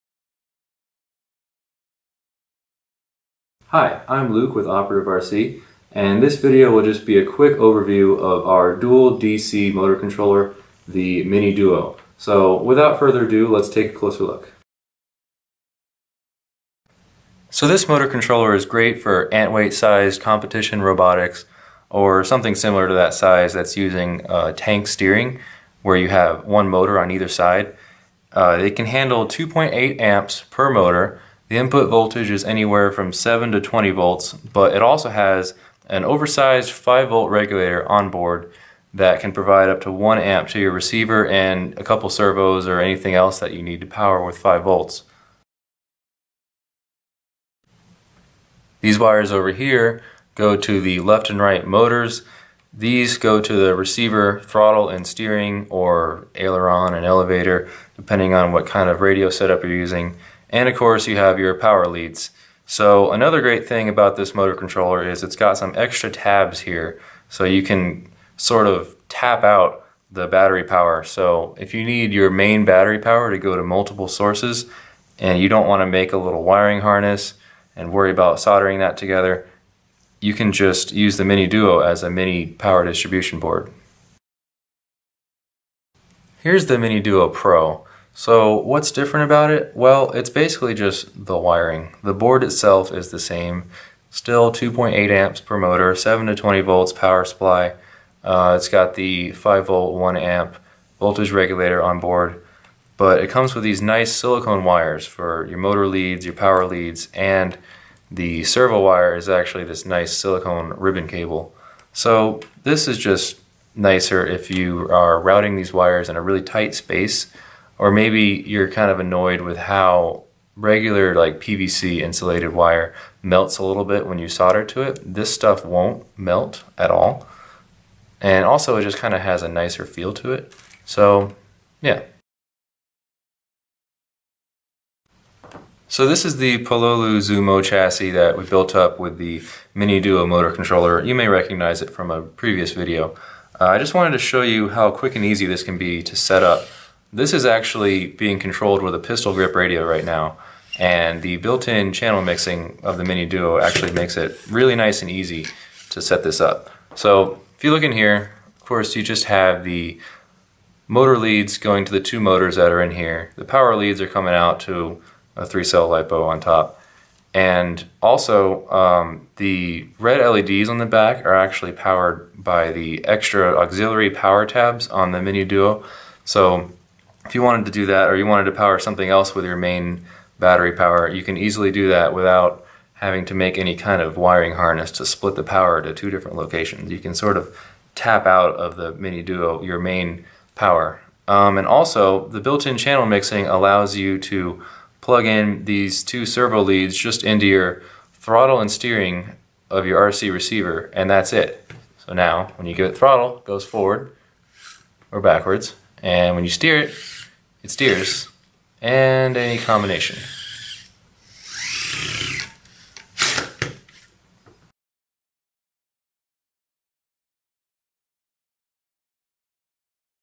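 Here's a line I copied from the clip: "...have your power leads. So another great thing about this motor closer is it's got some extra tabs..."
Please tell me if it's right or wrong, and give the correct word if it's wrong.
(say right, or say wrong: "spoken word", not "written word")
wrong: "controller", not "closer".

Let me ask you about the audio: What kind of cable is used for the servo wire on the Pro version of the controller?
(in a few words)
silicone ribbon cable.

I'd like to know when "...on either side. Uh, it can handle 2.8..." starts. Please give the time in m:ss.
0:26.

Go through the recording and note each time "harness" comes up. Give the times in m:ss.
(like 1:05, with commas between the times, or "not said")
1:16, 3:04.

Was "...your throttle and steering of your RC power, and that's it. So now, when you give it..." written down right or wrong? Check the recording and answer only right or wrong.
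wrong.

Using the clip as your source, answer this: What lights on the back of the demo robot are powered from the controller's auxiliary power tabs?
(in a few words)
red LEDs.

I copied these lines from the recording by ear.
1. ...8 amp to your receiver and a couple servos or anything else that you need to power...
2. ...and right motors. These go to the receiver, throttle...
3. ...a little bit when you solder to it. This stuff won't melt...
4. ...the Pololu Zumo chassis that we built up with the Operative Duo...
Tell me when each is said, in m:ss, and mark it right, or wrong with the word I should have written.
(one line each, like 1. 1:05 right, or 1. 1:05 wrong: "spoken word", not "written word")
1. 0:39 wrong: "1", not "8"
2. 0:51 right
3. 2:03 right
4. 2:16 wrong: "Mini", not "Operative".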